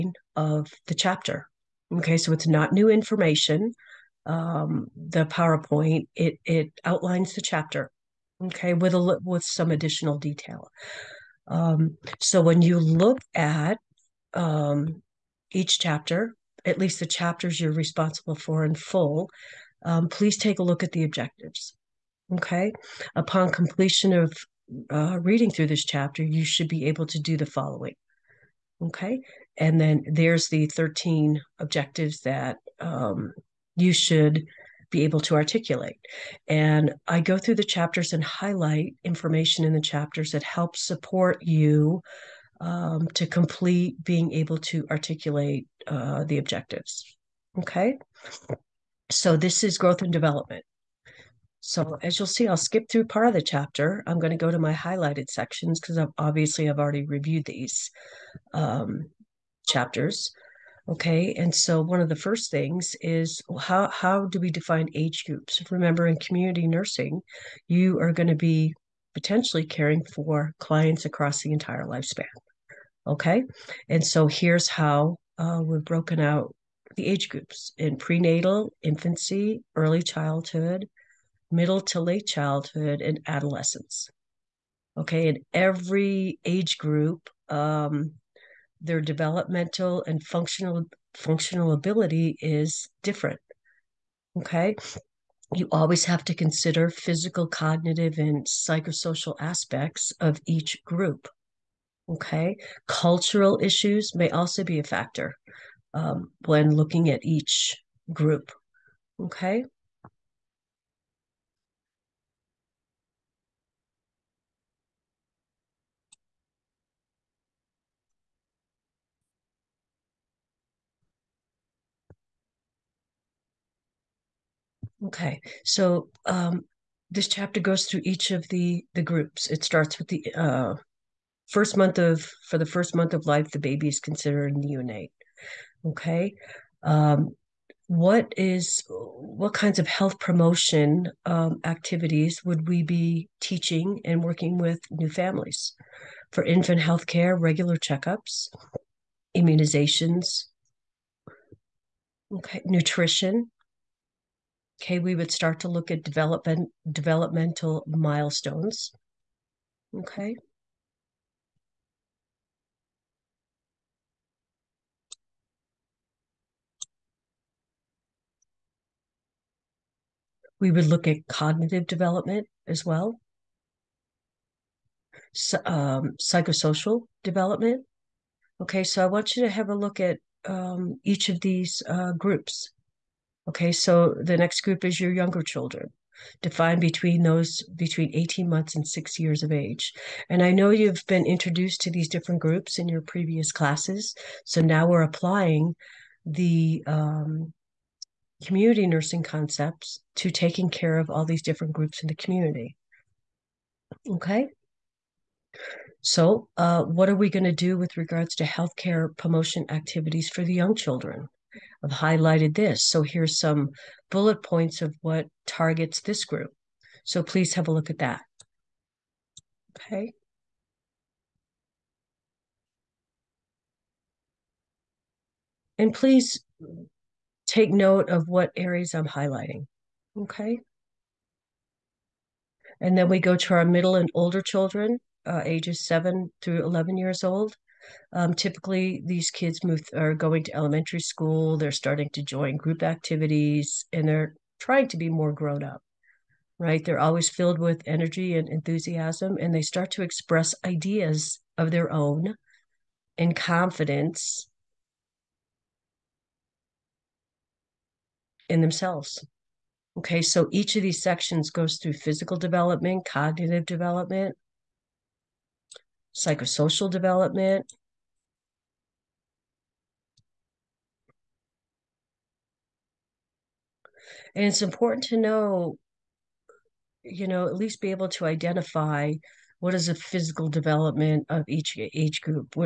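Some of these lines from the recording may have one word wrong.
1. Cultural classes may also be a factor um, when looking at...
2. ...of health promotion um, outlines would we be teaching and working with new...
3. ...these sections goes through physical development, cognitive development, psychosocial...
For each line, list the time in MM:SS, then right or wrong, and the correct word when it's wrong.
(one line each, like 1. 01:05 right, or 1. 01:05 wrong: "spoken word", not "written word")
1. 01:42 wrong: "issues", not "classes"
2. 02:19 wrong: "activities", not "outlines"
3. 04:20 right.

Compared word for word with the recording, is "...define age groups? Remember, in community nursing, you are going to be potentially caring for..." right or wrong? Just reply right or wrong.
right.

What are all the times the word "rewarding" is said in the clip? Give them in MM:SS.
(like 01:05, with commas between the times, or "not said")
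not said.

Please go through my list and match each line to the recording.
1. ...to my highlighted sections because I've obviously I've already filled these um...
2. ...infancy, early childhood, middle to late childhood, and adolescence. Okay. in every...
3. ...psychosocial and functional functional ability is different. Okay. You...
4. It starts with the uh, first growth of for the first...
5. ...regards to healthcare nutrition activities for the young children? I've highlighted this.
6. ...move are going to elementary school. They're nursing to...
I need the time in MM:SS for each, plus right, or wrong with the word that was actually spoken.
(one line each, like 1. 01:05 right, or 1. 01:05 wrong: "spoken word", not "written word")
1. 00:54 wrong: "reviewed", not "filled"
2. 01:18 right
3. 01:28 wrong: "developmental", not "psychosocial"
4. 02:09 wrong: "month", not "growth"
5. 03:27 wrong: "promotion", not "nutrition"
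6. 03:59 wrong: "starting", not "nursing".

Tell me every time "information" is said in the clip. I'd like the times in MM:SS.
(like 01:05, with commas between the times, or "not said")
00:02, 00:39.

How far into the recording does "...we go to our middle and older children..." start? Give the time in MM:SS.
03:53.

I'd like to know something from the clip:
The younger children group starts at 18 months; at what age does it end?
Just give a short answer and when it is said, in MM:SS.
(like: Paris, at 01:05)
6 years, at 03:08.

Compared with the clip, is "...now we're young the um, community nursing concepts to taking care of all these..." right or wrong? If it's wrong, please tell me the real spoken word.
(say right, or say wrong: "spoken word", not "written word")
wrong: "applying", not "young".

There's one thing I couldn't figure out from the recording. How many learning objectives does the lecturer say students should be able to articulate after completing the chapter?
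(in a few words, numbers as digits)
13.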